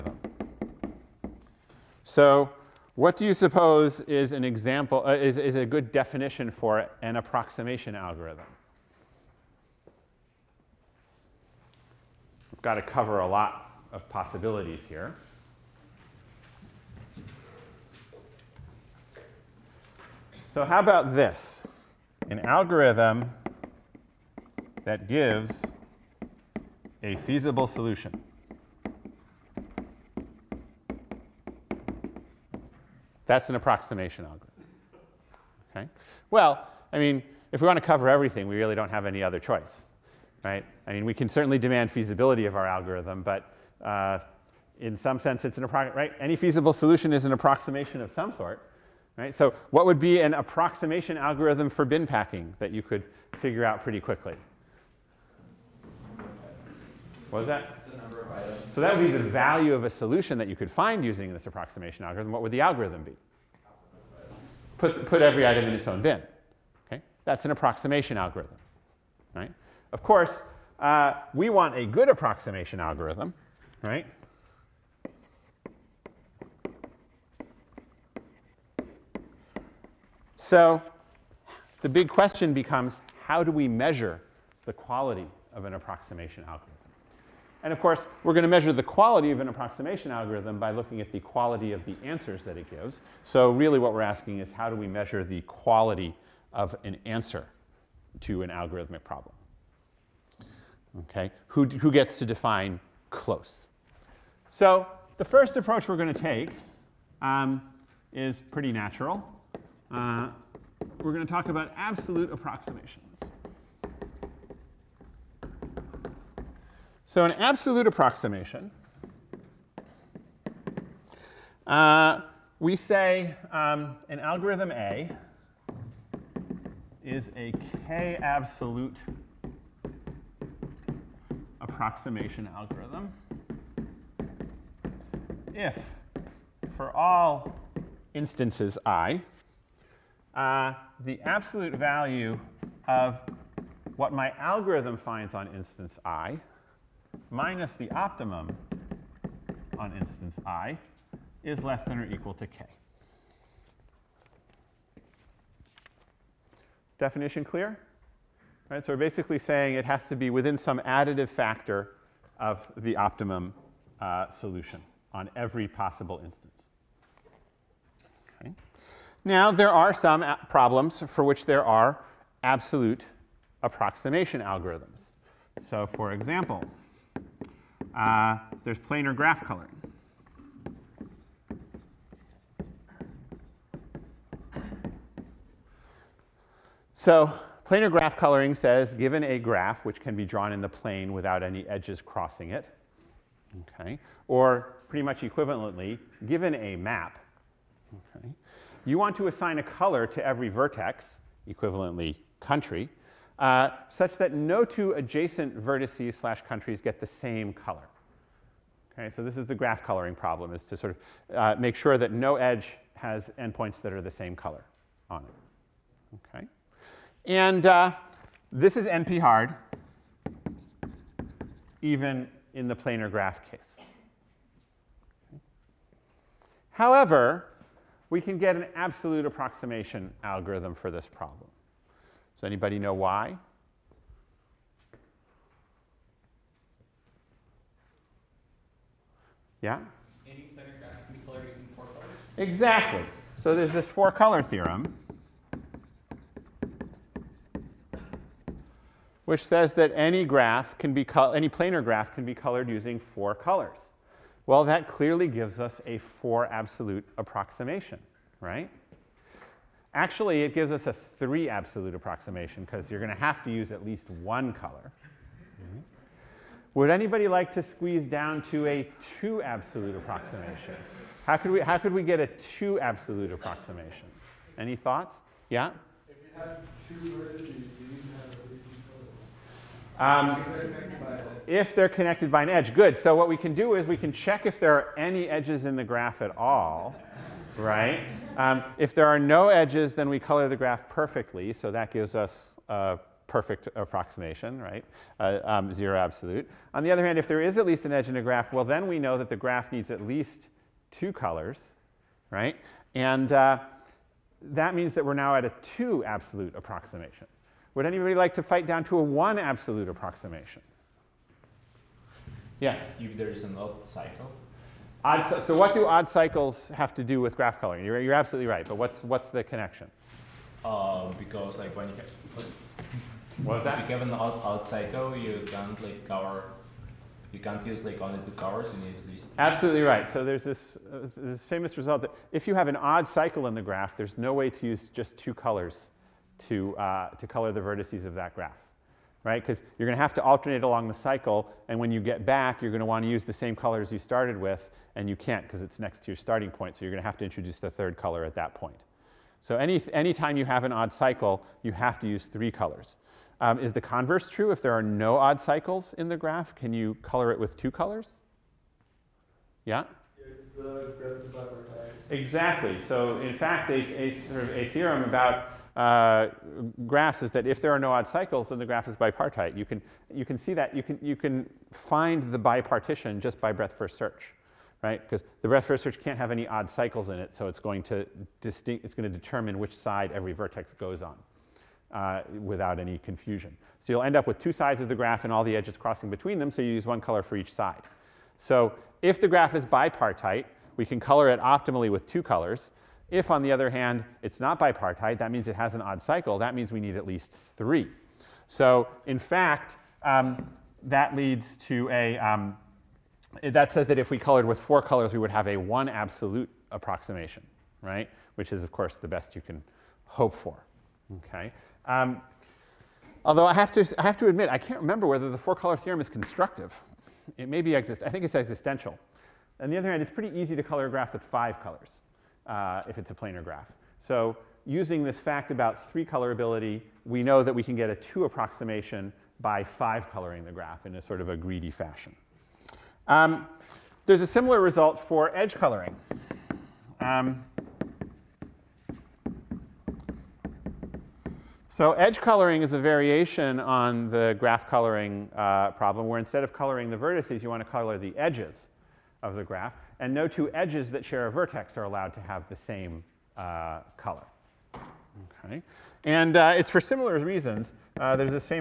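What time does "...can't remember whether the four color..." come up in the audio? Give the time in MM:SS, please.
06:54.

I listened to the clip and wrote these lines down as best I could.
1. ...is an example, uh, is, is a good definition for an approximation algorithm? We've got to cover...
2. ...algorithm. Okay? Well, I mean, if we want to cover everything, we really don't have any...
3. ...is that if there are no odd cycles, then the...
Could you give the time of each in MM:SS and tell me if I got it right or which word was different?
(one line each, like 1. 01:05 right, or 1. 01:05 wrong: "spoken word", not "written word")
1. 00:04 right
2. 00:34 right
3. 06:07 right.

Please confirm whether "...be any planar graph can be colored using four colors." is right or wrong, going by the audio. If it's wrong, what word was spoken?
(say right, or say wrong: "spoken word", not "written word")
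right.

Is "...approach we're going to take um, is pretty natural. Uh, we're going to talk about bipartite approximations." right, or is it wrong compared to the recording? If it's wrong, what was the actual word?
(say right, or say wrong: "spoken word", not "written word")
wrong: "absolute", not "bipartite".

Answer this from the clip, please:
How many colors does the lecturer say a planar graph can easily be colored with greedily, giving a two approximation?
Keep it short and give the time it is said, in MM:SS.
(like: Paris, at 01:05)
5, at 07:01.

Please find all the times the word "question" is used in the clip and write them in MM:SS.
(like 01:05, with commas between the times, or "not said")
01:22.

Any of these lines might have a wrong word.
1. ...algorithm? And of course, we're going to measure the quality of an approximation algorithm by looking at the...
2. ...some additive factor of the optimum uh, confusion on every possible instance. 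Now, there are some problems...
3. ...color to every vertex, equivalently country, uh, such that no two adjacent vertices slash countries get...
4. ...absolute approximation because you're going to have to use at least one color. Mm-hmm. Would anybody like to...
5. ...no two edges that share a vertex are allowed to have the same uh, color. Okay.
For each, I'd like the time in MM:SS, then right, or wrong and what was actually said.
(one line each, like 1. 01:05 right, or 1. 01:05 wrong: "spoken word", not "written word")
1. 01:26 right
2. 02:40 wrong: "solution", not "confusion"
3. 03:19 right
4. 04:21 right
5. 07:30 right.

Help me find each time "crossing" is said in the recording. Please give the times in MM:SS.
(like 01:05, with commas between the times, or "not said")
03:11, 06:25.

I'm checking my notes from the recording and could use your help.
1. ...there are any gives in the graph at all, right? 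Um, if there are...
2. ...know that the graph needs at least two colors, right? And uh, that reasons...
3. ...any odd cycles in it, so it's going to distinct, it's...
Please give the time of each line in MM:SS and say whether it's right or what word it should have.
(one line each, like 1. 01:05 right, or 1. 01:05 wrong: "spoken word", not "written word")
1. 04:44 wrong: "edges", not "gives"
2. 04:58 wrong: "means", not "reasons"
3. 06:16 right.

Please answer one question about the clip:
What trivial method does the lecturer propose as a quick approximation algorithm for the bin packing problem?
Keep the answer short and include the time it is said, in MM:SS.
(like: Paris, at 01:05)
Put every item in its own bin, at 01:04.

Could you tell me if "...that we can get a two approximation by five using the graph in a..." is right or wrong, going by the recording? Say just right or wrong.
wrong.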